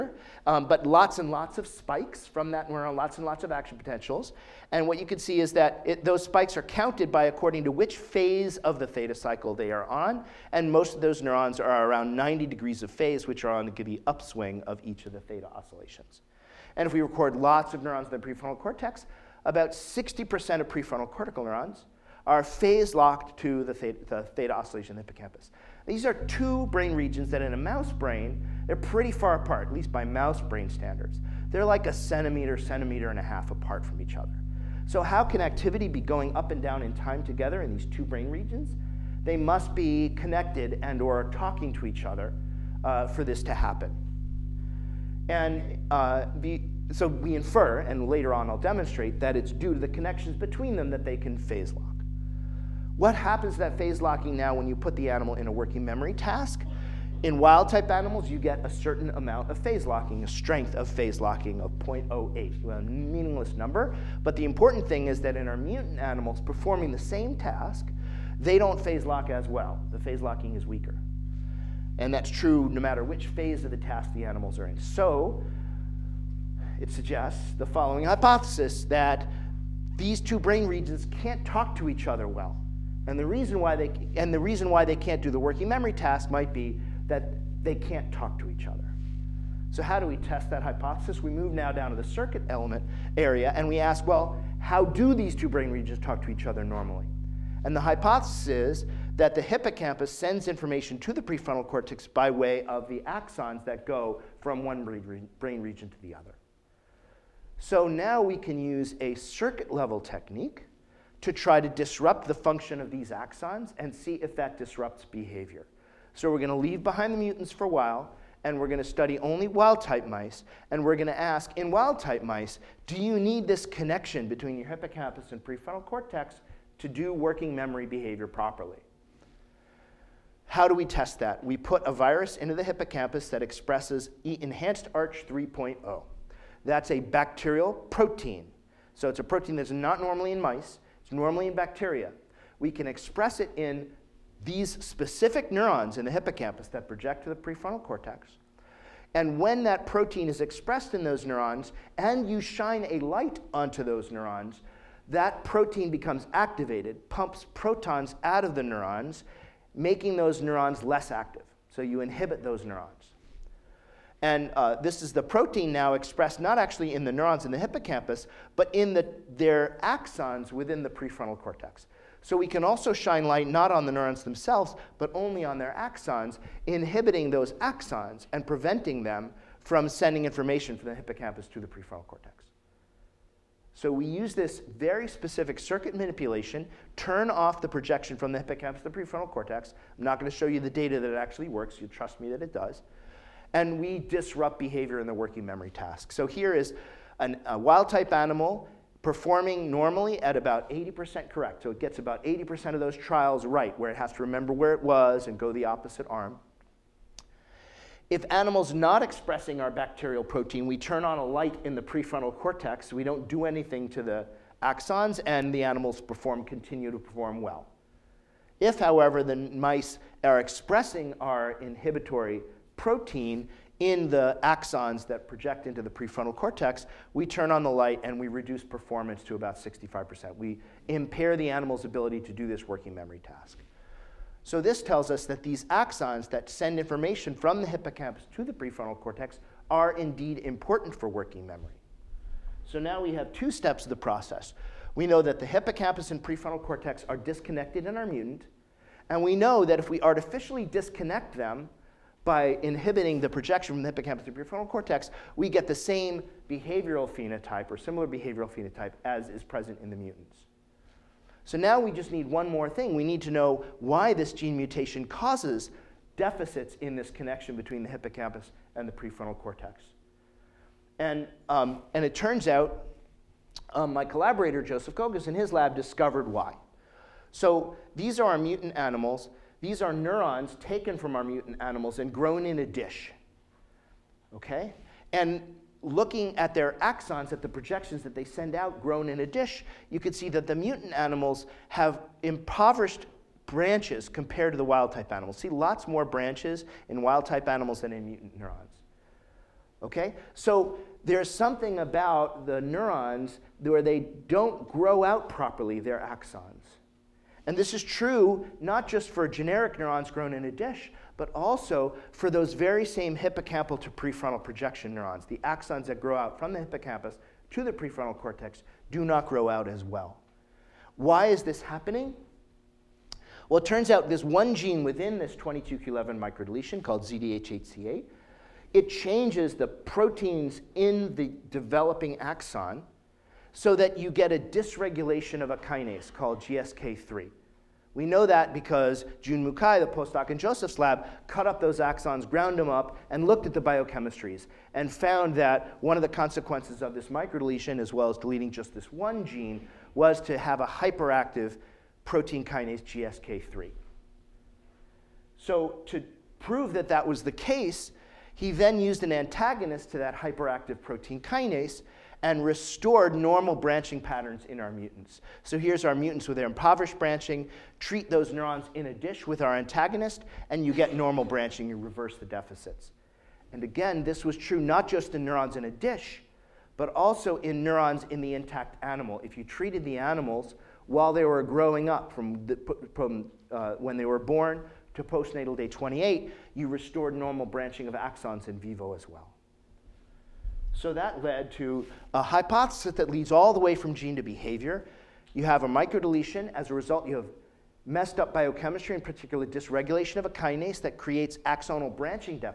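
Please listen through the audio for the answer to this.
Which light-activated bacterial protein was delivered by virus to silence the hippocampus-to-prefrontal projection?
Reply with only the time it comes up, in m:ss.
2:14.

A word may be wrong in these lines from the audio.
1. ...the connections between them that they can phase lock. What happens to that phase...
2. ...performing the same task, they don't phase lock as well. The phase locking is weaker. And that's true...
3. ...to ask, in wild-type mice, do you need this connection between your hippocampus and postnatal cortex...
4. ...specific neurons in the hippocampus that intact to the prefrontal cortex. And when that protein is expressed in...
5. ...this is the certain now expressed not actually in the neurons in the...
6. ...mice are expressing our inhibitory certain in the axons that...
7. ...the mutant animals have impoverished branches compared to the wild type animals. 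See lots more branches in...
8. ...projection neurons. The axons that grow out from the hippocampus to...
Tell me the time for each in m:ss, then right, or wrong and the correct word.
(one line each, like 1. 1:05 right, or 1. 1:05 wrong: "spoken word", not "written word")
1. 0:49 right
2. 1:06 right
3. 2:01 wrong: "prefrontal", not "postnatal"
4. 2:24 wrong: "project", not "intact"
5. 2:44 wrong: "protein", not "certain"
6. 3:39 wrong: "protein", not "certain"
7. 4:50 right
8. 5:14 right.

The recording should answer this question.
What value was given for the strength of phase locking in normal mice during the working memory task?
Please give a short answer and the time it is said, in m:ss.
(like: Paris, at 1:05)
0.08, at 1:01.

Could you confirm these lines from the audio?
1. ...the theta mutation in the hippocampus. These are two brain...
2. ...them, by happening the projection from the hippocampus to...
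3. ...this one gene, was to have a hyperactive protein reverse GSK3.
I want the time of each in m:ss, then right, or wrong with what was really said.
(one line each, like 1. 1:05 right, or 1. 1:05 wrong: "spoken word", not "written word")
1. 0:24 wrong: "oscillation", not "mutation"
2. 4:11 wrong: "inhibiting", not "happening"
3. 5:48 wrong: "kinase", not "reverse".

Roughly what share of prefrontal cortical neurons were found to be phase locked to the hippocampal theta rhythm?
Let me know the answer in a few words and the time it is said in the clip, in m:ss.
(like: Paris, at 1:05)
60%, at 0:19.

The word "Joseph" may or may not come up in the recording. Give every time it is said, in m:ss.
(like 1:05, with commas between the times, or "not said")
4:34, 5:40.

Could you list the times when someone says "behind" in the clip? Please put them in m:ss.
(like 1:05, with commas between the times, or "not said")
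1:56.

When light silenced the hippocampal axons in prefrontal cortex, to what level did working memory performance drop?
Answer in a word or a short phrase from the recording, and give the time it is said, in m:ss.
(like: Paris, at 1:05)
65%, at 3:49.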